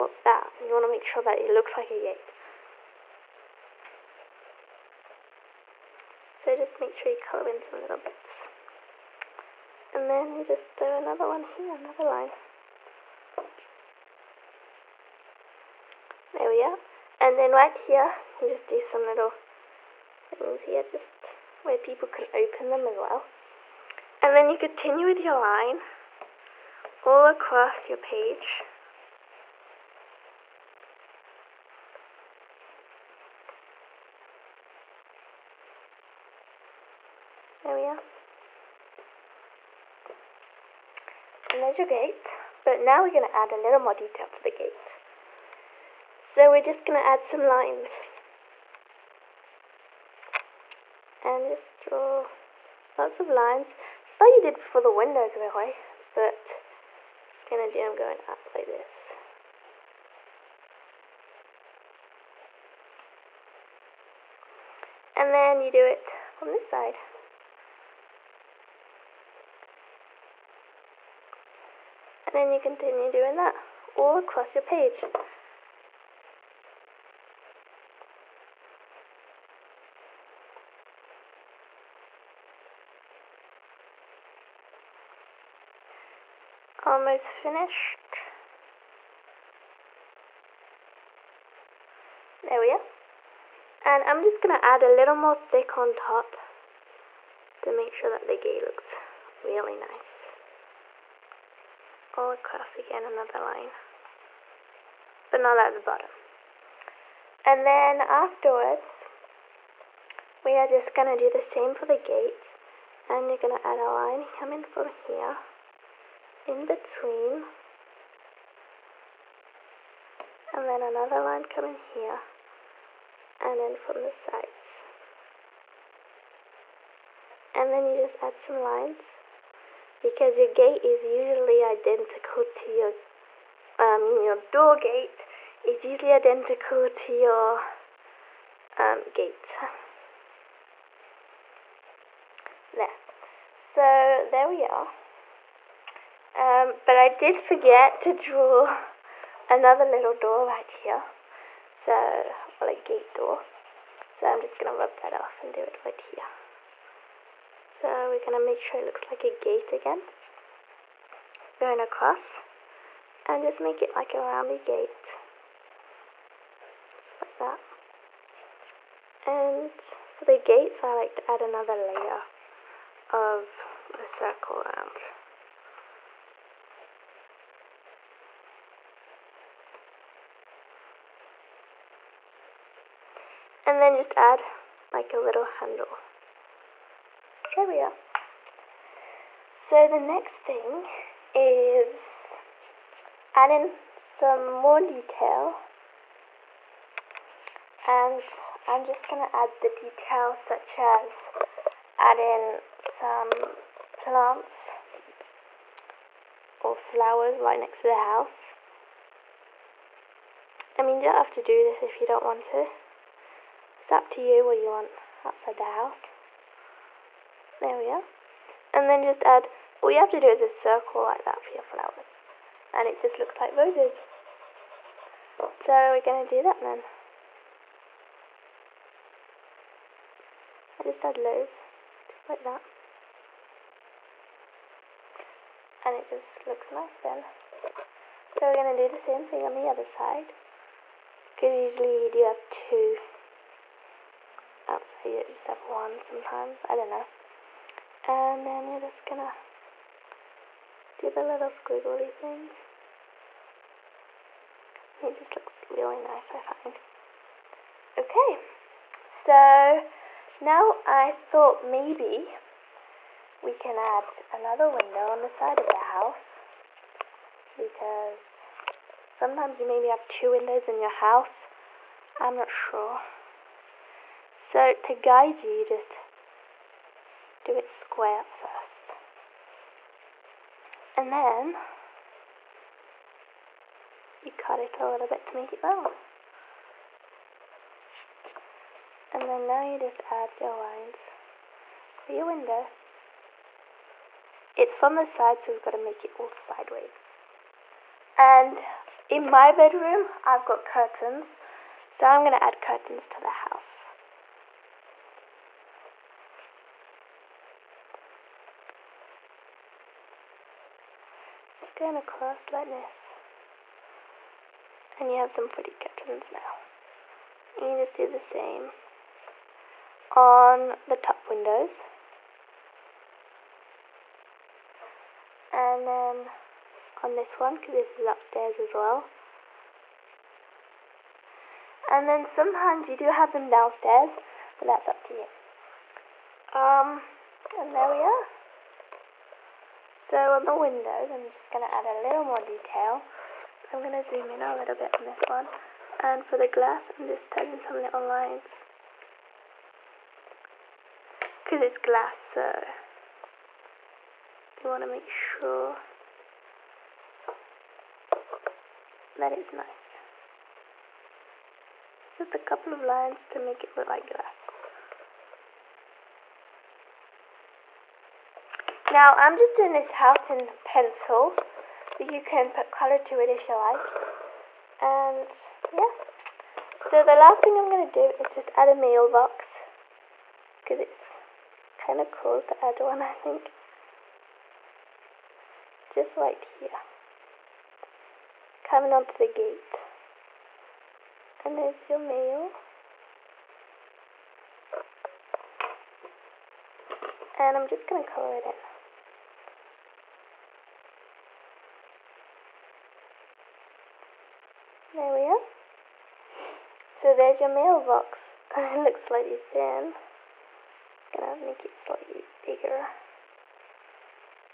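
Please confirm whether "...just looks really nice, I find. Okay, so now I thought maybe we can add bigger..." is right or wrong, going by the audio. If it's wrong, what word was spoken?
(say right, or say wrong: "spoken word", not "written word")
wrong: "another", not "bigger".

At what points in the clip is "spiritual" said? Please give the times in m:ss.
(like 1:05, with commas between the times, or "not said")
not said.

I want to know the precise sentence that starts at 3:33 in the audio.
It's up to you what you want outside the house.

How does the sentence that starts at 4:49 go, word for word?
And then now you just add your lines for your window.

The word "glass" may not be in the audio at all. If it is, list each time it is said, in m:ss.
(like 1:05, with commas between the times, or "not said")
5:46, 5:51, 6:04.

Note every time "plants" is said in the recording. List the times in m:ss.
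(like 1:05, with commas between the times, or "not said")
3:23.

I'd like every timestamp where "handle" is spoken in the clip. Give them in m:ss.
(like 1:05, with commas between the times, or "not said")
3:05.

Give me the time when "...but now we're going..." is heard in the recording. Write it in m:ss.
0:42.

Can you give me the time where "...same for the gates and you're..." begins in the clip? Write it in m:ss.
1:51.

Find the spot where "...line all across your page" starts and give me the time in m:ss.
0:25.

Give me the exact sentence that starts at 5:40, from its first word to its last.
So on the windows, I'm just going to add a little more detail.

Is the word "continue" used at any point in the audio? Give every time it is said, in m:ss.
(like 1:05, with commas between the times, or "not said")
0:24, 1:12.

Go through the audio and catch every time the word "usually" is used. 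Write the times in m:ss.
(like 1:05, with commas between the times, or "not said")
2:11, 2:15, 4:01.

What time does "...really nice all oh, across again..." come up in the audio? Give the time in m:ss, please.
1:39.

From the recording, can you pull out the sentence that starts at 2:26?
Um, but I did forget to draw another little door right here.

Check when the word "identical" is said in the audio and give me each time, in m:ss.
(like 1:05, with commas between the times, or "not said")
2:11, 2:16.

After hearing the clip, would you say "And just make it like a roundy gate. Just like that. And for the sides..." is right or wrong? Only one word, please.
wrong.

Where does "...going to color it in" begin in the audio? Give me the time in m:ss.
6:37.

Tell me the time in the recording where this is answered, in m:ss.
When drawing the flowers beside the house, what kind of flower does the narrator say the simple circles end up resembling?
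3:43.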